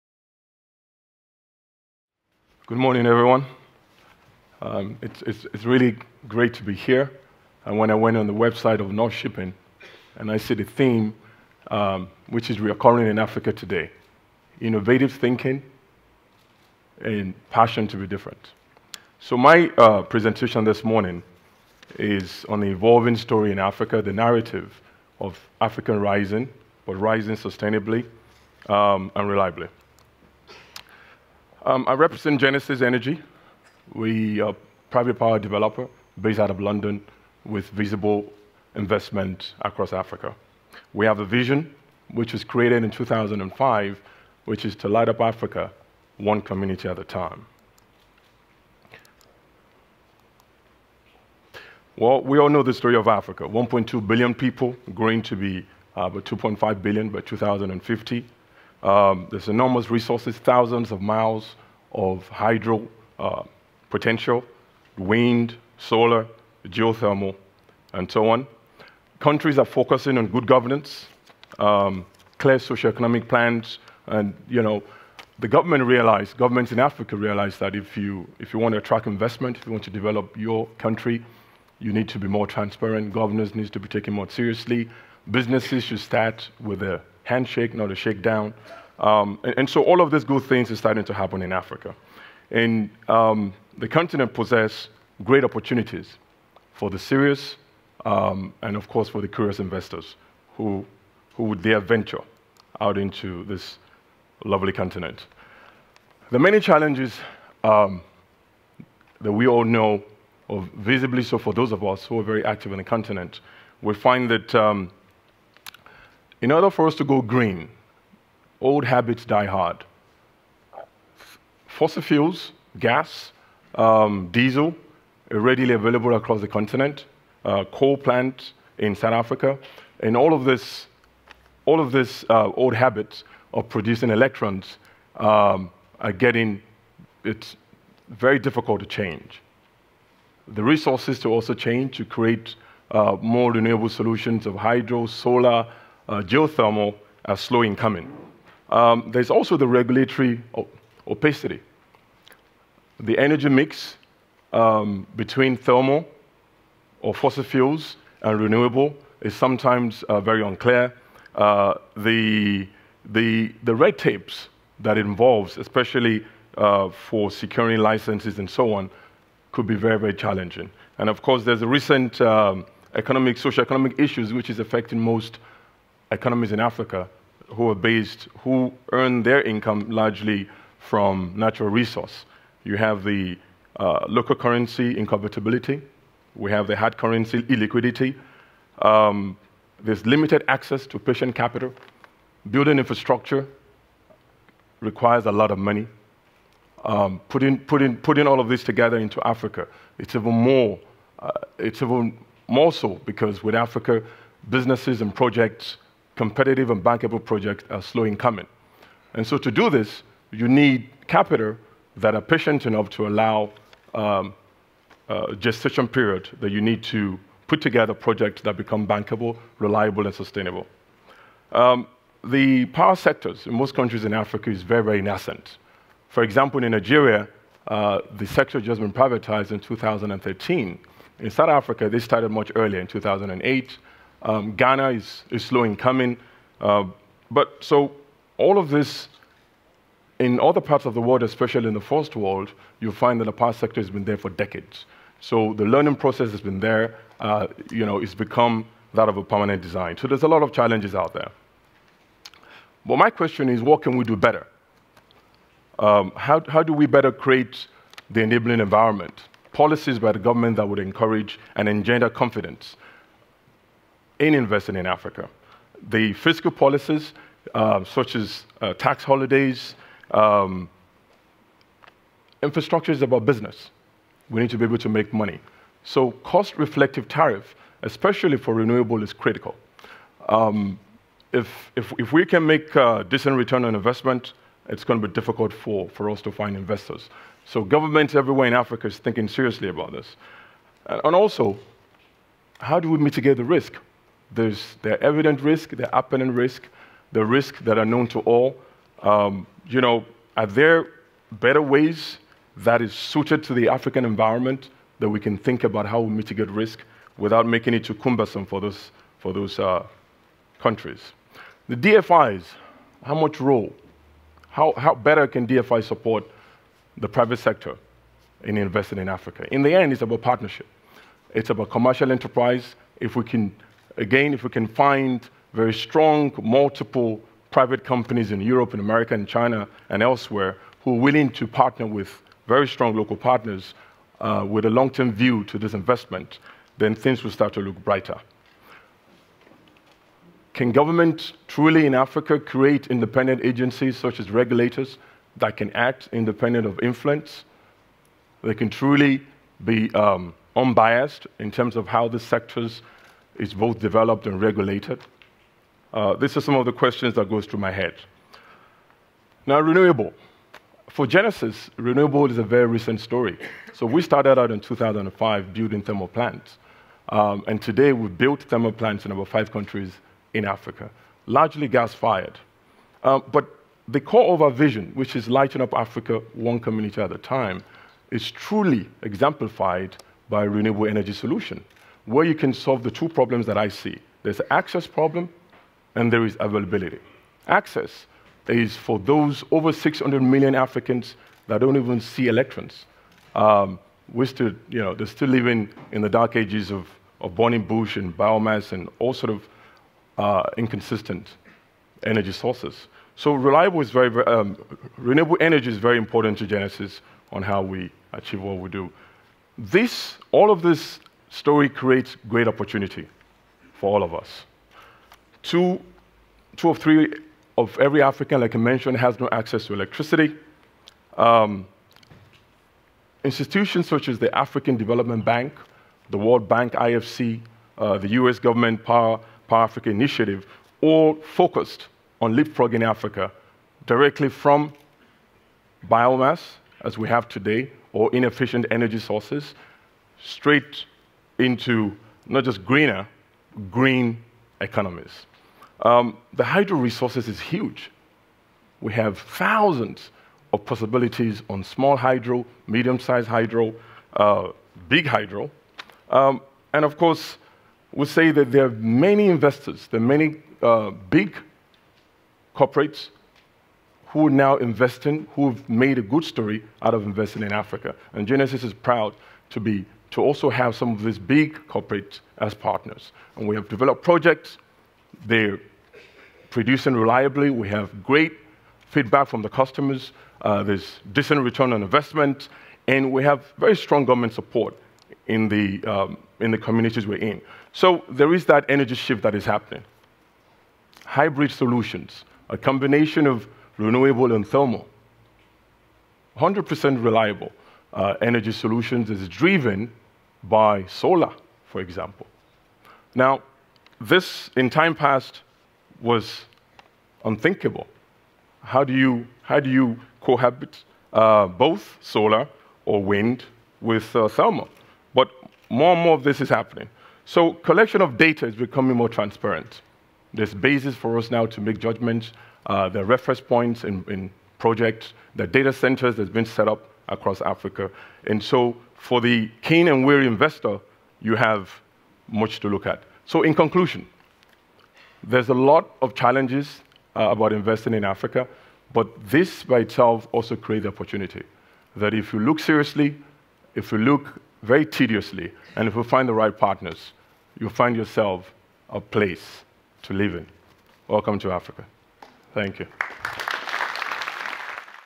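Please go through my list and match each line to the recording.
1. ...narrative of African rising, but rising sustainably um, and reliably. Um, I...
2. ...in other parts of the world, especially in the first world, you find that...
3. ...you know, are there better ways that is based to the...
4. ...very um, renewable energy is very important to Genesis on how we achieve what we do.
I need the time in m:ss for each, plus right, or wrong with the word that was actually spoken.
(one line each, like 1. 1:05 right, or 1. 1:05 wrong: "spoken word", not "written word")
1. 0:24 right
2. 4:00 right
3. 4:59 wrong: "suited", not "based"
4. 6:44 right.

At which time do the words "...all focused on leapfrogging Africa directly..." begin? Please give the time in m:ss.
7:10.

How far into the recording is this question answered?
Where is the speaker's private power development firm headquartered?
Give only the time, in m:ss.
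0:36.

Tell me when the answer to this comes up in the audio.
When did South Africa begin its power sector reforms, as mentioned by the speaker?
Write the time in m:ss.
3:52.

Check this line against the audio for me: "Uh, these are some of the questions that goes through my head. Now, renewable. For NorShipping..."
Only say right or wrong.
wrong.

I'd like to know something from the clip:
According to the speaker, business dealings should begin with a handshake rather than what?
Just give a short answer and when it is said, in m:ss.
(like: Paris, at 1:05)
a shakedown, at 1:27.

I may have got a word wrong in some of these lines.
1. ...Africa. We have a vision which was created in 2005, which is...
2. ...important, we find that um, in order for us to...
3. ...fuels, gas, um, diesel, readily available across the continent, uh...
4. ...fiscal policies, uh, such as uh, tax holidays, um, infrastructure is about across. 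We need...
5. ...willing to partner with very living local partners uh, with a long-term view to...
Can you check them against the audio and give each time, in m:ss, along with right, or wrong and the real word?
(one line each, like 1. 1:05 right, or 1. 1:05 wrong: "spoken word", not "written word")
1. 0:39 right
2. 1:52 wrong: "continent", not "important"
3. 2:02 right
4. 4:26 wrong: "business", not "across"
5. 5:30 wrong: "strong", not "living".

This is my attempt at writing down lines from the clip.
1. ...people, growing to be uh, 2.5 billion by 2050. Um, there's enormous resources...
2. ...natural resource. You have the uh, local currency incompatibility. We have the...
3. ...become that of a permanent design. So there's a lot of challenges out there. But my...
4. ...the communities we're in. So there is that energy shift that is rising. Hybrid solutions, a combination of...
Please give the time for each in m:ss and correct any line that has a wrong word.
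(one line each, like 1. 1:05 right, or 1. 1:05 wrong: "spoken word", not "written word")
1. 0:54 right
2. 3:01 right
3. 4:08 right
4. 8:06 wrong: "happening", not "rising".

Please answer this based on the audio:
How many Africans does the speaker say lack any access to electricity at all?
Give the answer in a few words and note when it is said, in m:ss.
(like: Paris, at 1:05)
over 600 million, at 6:29.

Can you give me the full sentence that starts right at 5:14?
How, how better can DFI support the private sector in investing in Africa?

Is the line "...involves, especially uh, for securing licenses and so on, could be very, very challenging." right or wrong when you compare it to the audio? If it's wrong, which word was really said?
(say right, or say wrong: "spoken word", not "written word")
right.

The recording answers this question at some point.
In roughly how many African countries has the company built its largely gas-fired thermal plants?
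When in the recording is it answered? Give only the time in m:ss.
6:09.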